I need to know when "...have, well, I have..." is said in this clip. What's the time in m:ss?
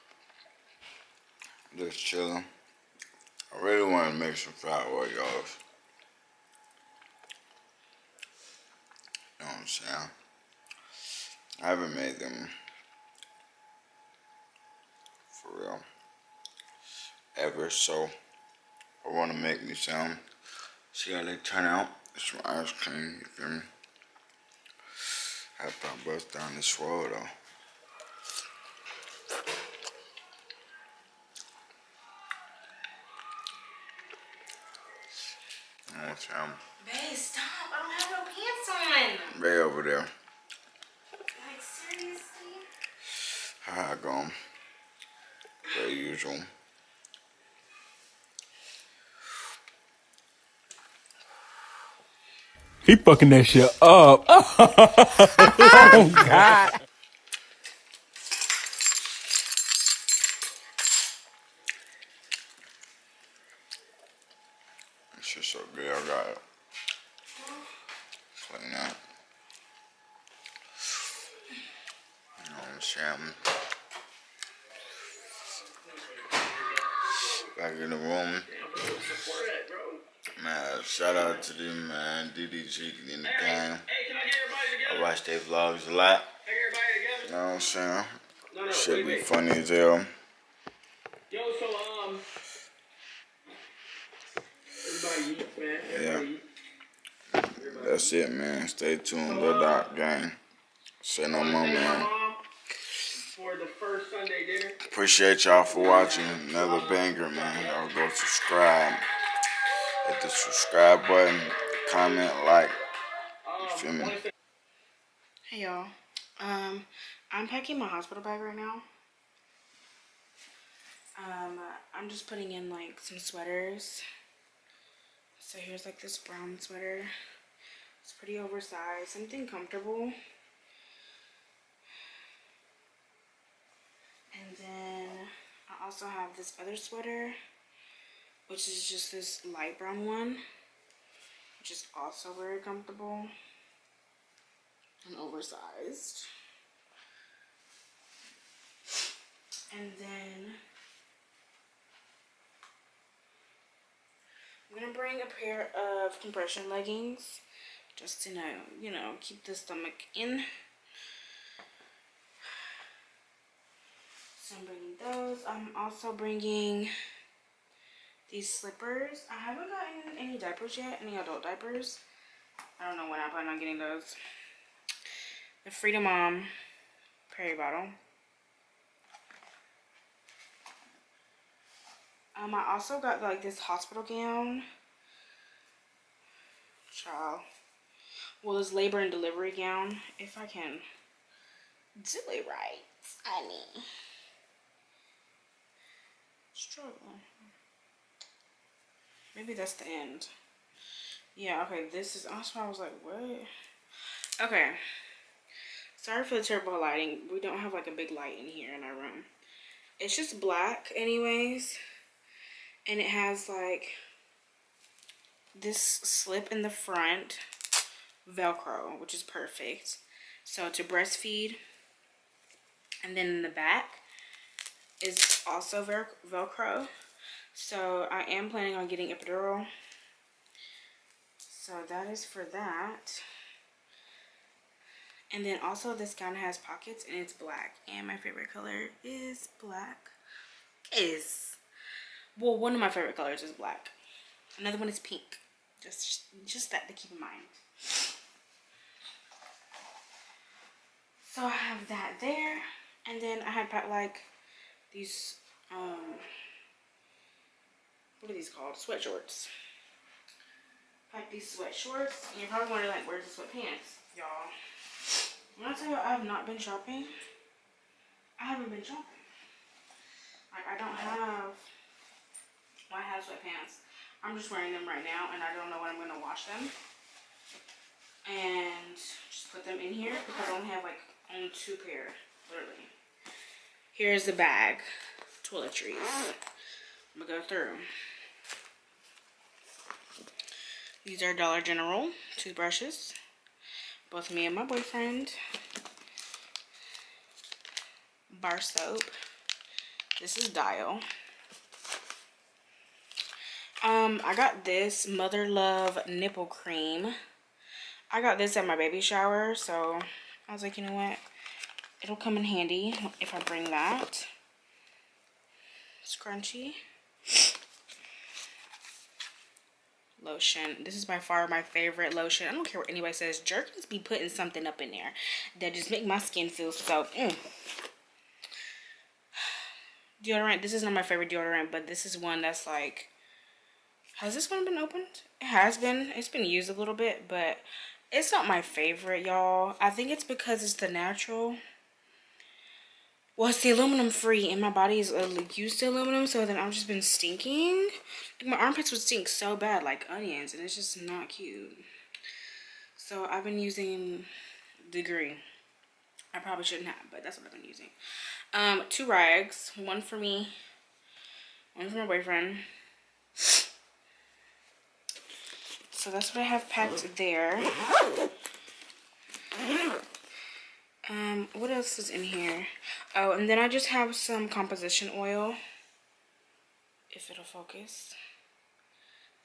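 4:30.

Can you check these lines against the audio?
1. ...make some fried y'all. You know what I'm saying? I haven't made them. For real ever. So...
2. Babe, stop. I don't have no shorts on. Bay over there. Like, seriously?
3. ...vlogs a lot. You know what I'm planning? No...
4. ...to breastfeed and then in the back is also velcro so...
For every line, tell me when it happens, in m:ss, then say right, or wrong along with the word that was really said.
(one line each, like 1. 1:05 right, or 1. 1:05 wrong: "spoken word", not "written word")
1. 0:04 right
2. 0:36 wrong: "pants", not "shorts"
3. 1:25 wrong: "saying", not "planning"
4. 3:40 right.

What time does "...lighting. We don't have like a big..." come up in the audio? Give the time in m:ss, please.
3:26.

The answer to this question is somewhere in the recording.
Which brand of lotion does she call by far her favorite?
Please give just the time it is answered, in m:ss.
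5:23.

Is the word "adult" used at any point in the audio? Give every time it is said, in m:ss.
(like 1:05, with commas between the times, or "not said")
2:51.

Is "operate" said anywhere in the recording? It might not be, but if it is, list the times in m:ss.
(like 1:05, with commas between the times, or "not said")
not said.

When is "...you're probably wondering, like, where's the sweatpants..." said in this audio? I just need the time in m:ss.
4:22.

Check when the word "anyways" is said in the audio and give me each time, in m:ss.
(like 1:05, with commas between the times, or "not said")
3:30.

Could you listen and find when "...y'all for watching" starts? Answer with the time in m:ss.
1:45.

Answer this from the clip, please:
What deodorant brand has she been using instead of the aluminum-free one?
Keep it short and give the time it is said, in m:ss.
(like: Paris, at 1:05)
Degree, at 5:54.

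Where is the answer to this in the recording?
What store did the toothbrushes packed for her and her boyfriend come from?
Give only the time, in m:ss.
4:51.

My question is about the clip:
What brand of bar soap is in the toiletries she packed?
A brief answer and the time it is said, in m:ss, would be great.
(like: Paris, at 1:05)
Dial, at 5:00.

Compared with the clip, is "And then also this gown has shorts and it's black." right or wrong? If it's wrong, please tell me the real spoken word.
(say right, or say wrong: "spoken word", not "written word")
wrong: "pockets", not "shorts".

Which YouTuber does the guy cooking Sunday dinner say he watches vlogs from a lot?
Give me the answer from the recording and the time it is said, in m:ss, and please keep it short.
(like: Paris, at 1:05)
DDG, at 1:22.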